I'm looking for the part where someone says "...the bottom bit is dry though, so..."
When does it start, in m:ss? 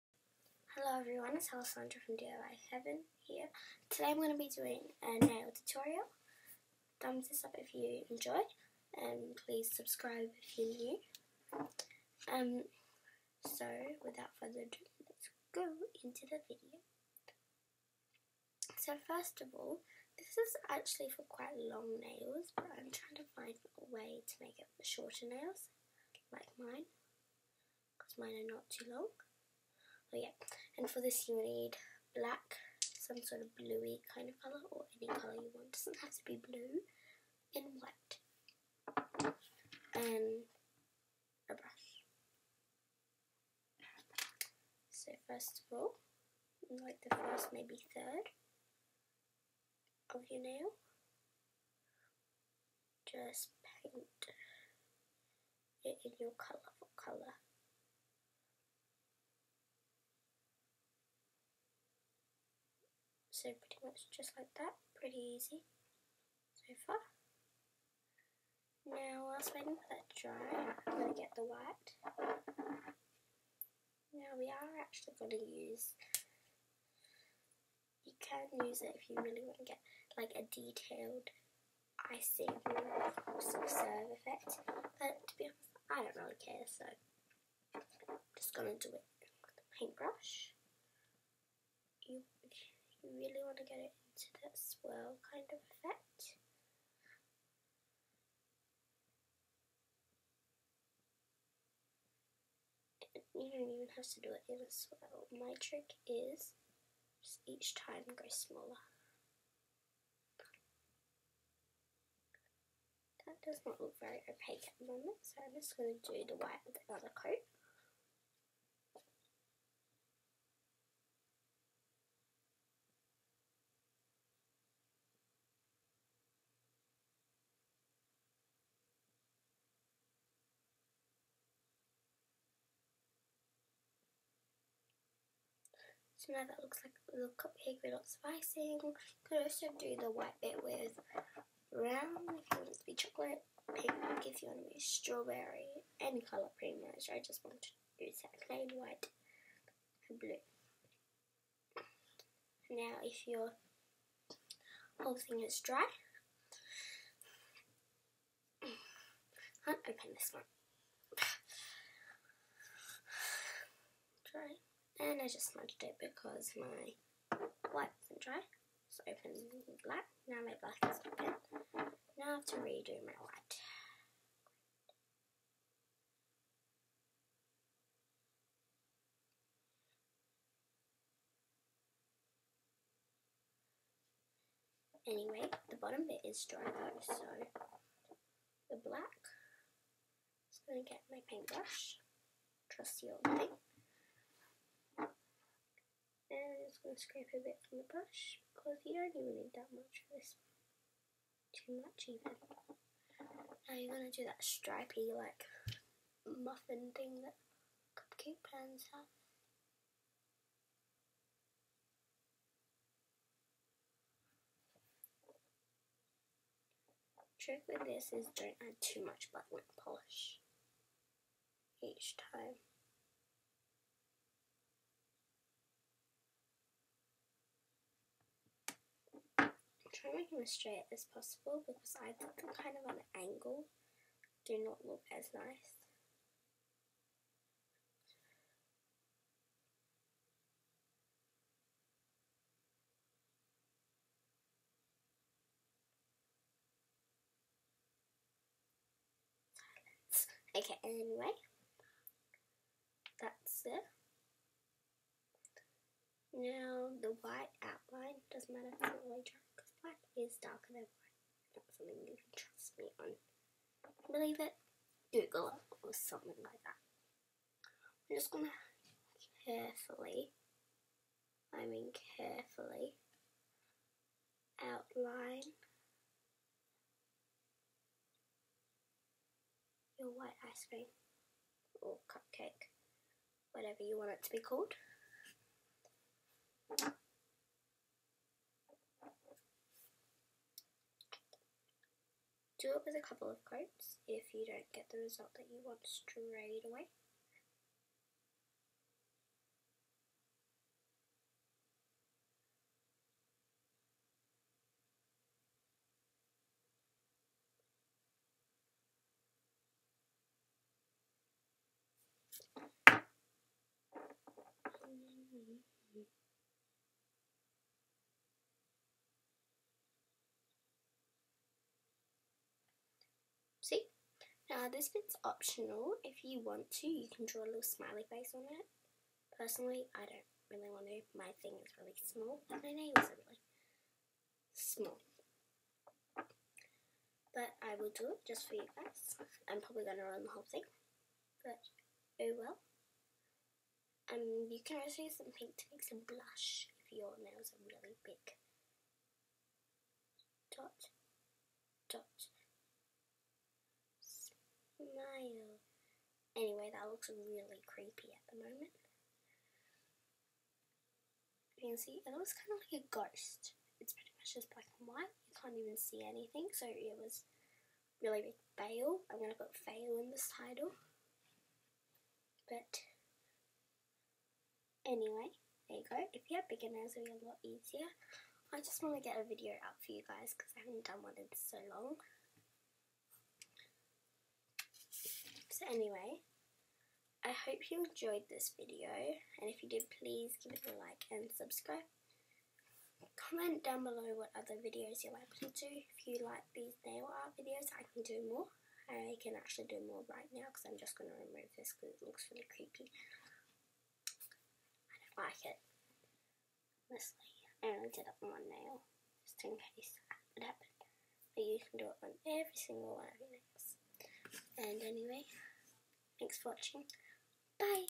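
3:05.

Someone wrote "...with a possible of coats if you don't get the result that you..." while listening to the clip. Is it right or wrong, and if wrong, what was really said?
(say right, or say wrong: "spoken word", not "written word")
wrong: "couple", not "possible".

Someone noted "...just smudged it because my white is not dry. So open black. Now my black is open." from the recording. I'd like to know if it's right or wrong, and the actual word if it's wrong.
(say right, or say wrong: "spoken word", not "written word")
right.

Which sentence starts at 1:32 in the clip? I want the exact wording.
You you really want to get it into that swirl kind of effect.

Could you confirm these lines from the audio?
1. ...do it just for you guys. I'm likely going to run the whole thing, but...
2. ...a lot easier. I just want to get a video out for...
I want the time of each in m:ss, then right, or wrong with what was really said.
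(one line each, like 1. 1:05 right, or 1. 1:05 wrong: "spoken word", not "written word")
1. 5:37 wrong: "probably", not "likely"
2. 6:17 right.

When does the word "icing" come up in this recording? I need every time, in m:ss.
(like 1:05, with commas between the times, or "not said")
1:22, 2:18.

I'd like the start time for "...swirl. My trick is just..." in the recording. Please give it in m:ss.
1:44.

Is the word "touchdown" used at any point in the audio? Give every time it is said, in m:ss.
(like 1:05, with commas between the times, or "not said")
not said.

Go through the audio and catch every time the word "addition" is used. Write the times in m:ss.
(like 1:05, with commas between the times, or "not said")
not said.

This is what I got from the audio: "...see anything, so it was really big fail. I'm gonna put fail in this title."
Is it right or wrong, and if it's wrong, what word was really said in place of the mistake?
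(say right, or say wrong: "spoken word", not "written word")
right.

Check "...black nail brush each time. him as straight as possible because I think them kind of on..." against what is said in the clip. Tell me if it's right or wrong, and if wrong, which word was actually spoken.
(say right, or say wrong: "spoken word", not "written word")
wrong: "polish", not "brush".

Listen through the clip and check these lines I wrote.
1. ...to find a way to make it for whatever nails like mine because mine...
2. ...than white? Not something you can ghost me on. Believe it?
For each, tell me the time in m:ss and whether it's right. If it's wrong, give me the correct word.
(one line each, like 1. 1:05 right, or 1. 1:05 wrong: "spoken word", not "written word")
1. 0:23 wrong: "shorter", not "whatever"
2. 4:20 wrong: "trust", not "ghost".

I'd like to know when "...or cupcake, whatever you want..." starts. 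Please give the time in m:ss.
4:41.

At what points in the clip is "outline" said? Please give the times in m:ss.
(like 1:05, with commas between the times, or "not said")
4:17, 4:34.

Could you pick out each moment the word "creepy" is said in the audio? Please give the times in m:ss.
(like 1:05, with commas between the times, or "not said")
5:57, 6:42.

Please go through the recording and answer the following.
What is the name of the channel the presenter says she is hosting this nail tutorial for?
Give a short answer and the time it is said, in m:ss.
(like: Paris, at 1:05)
DIY Heaven, at 0:02.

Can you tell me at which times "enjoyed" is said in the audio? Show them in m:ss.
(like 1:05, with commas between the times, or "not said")
0:08, 6:27.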